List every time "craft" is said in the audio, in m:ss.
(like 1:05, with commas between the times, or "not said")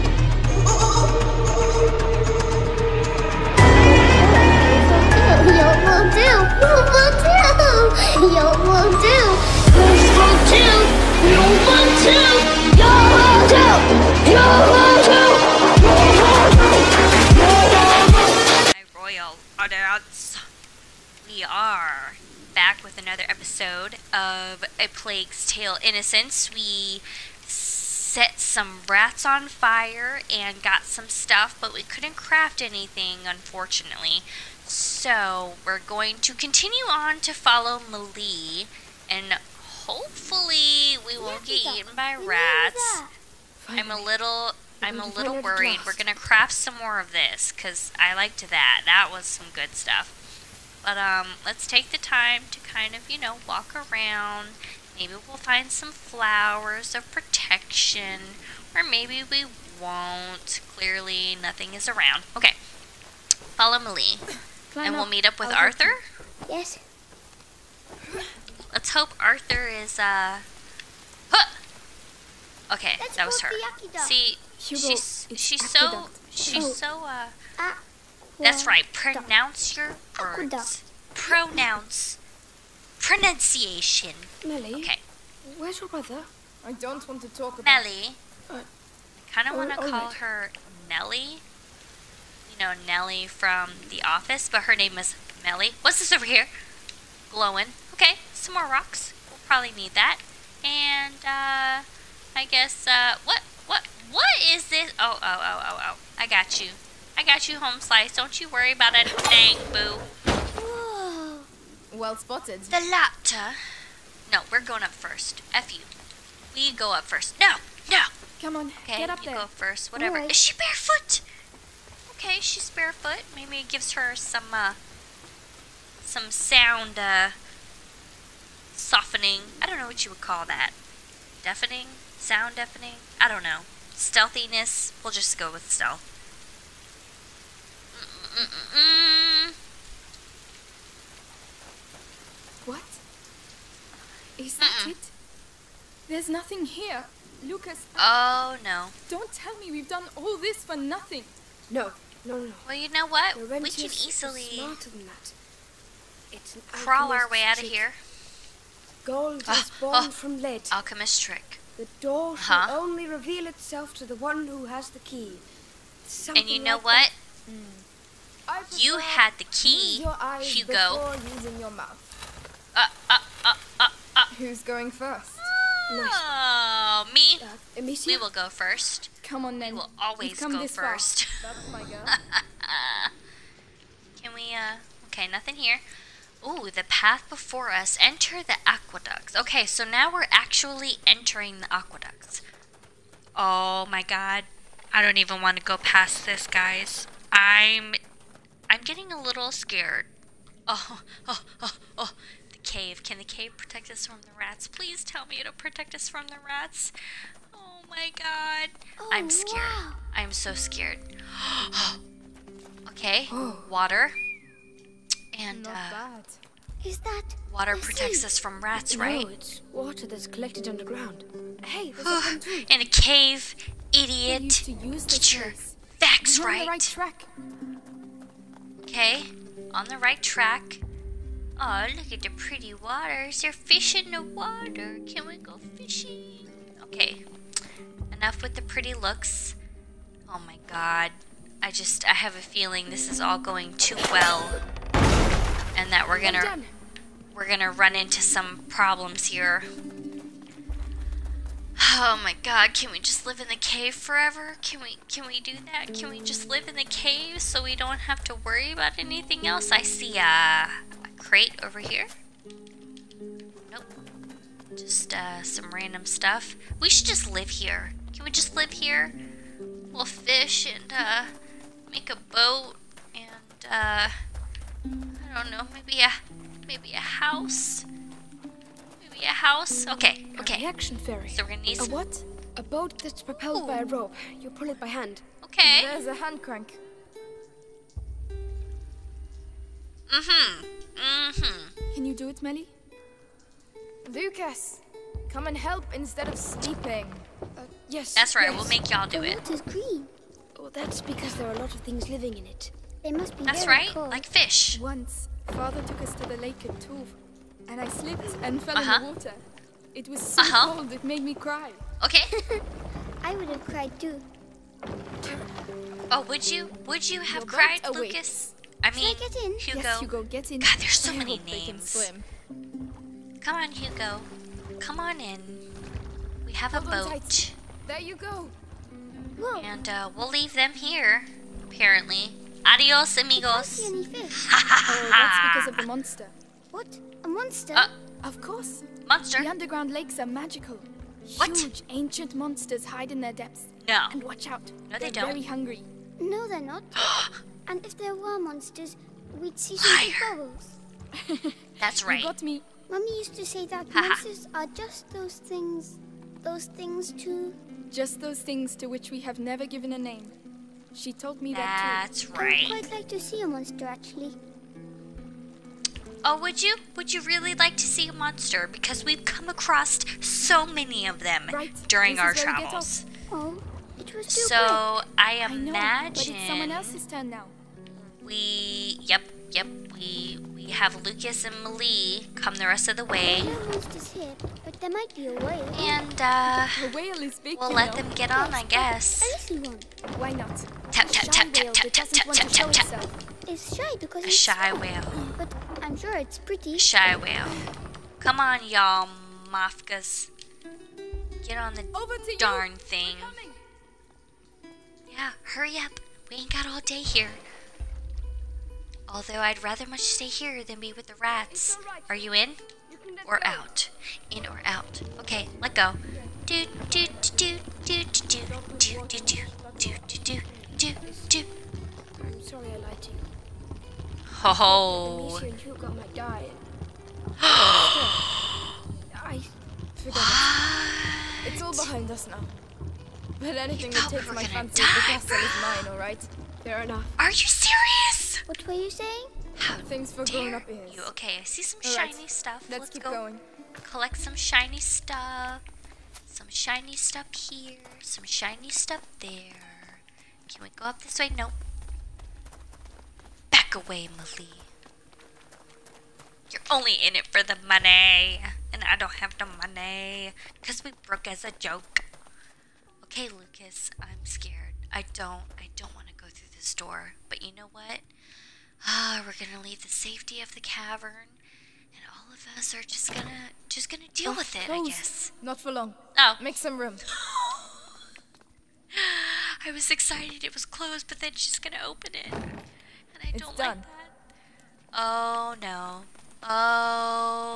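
0:32, 0:46.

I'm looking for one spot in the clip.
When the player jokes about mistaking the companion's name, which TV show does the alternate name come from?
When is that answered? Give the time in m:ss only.
1:33.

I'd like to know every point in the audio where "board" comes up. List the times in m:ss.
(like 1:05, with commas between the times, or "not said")
not said.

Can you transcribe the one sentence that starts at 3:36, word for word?
Is that water protects us from rats, right?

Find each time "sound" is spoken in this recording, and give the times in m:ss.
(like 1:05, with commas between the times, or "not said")
2:06, 2:12.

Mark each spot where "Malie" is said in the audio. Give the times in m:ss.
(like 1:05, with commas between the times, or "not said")
0:37, 1:03, 6:21, 7:34.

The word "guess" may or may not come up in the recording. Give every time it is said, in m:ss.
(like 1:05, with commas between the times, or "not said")
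1:42, 6:28, 7:54.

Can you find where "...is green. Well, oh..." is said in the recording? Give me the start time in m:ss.
4:59.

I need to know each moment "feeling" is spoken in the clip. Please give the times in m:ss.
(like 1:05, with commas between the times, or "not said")
4:02.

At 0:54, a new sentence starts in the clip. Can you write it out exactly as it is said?
Maybe we'll find some flowers of protection, or maybe we won't.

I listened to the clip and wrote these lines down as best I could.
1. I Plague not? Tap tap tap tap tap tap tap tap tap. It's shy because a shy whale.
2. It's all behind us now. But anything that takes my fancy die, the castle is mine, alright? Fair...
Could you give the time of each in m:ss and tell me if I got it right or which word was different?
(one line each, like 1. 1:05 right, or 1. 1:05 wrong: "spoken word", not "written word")
1. 6:29 wrong: "Why", not "Plague"
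2. 7:11 right.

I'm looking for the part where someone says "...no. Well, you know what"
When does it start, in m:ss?
2:32.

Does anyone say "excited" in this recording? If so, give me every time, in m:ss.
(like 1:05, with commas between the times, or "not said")
7:59.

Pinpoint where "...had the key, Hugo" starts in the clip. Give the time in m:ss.
2:48.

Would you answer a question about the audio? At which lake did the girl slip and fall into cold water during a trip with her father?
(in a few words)
Tuve.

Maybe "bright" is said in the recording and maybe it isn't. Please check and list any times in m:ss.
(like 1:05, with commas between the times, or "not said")
not said.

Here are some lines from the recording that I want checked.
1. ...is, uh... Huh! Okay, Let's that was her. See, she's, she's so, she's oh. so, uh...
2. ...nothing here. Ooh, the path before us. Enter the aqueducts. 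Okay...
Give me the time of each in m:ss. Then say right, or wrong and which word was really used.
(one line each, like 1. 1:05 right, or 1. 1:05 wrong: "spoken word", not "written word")
1. 1:09 right
2. 3:05 right.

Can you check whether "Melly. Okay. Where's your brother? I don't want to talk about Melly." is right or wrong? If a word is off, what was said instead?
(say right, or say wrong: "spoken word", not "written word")
right.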